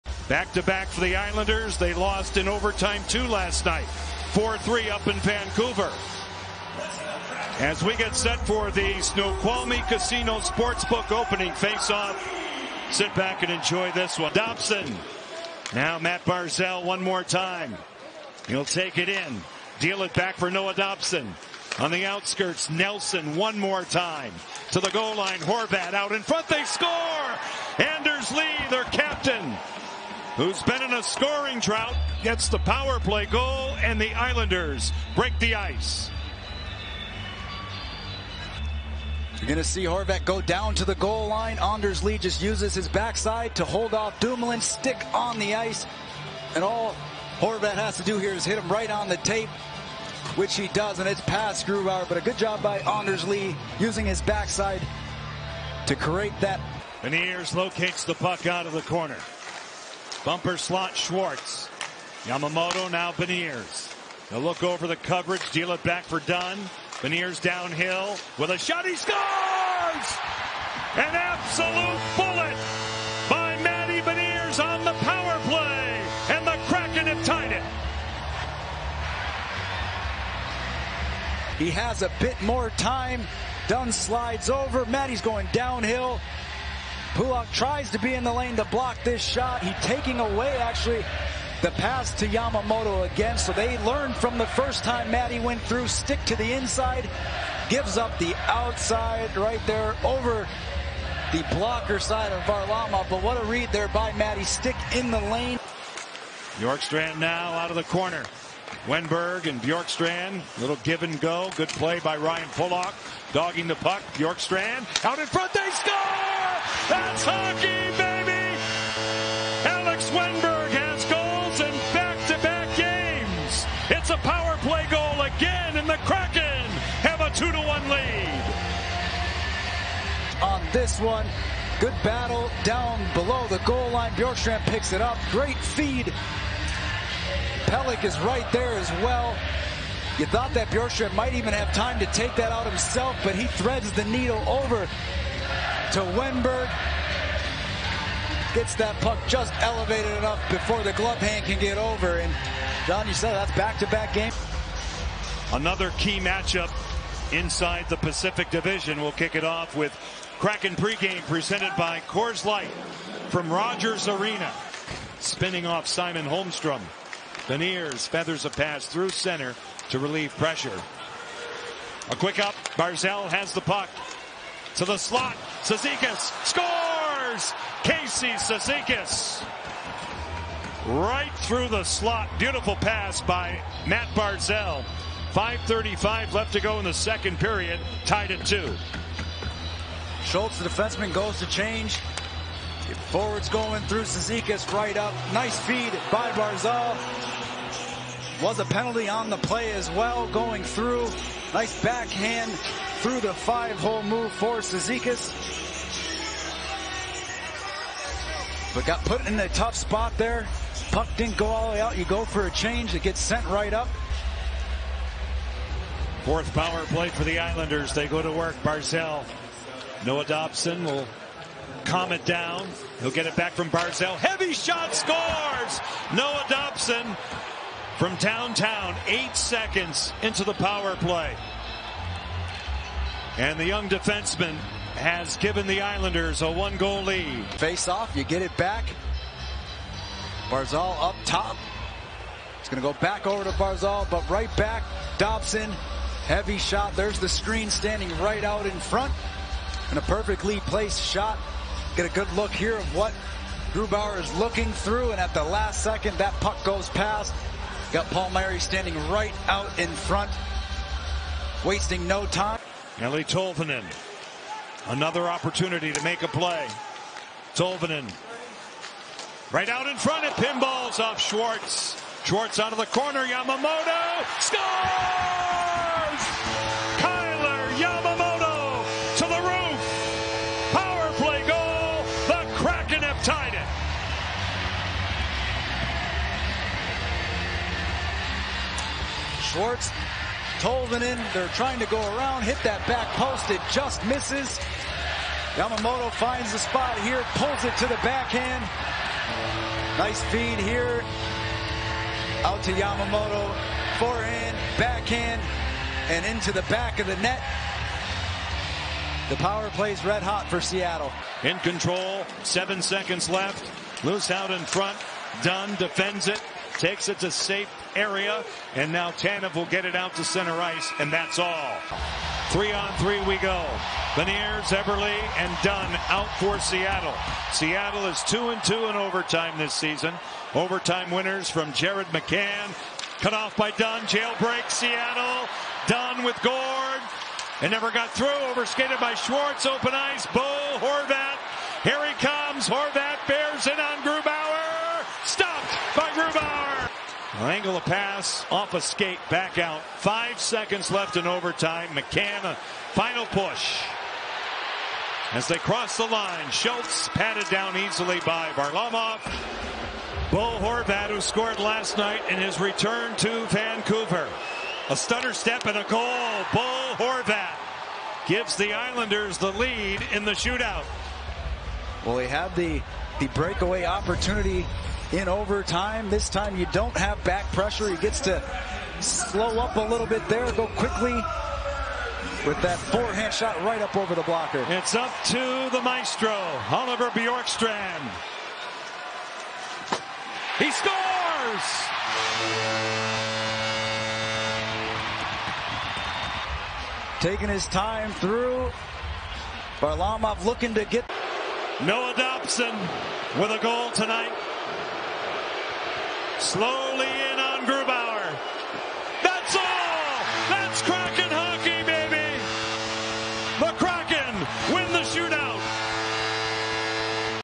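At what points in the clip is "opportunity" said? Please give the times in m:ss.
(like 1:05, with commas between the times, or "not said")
4:25, 6:13.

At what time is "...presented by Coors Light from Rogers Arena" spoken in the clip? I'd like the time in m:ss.
2:41.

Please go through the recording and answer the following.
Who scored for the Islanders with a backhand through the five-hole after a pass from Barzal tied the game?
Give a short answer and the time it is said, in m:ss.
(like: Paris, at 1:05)
Casey Cizikas, at 2:57.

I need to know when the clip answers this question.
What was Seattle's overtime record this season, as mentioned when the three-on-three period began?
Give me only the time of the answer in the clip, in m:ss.
5:28.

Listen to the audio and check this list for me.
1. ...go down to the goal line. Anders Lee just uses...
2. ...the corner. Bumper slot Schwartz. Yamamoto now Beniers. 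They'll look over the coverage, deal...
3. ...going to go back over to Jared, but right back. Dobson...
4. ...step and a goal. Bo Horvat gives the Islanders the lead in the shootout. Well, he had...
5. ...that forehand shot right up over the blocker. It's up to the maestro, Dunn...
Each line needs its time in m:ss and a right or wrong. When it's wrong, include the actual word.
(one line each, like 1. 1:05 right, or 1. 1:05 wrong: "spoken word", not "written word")
1. 0:40 right
2. 0:58 right
3. 4:02 wrong: "Barzal", not "Jared"
4. 6:05 right
5. 6:22 wrong: "Oliver", not "Dunn".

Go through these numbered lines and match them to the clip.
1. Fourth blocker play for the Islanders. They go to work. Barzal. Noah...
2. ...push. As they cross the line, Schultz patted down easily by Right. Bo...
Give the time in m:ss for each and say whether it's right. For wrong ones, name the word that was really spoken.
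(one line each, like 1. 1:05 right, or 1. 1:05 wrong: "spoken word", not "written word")
1. 3:36 wrong: "power", not "blocker"
2. 5:53 wrong: "Varlamov", not "Right".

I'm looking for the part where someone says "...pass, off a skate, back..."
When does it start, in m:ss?
5:47.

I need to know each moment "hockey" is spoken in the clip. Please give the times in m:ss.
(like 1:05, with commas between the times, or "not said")
1:57.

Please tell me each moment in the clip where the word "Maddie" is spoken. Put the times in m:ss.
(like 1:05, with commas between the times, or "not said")
1:35, 1:44.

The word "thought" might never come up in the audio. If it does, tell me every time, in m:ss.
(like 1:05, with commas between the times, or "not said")
2:20.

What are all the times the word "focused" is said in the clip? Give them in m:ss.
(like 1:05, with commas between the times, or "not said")
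not said.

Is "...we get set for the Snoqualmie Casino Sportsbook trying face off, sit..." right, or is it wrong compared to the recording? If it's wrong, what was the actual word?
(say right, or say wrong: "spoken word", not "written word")
wrong: "opening", not "trying".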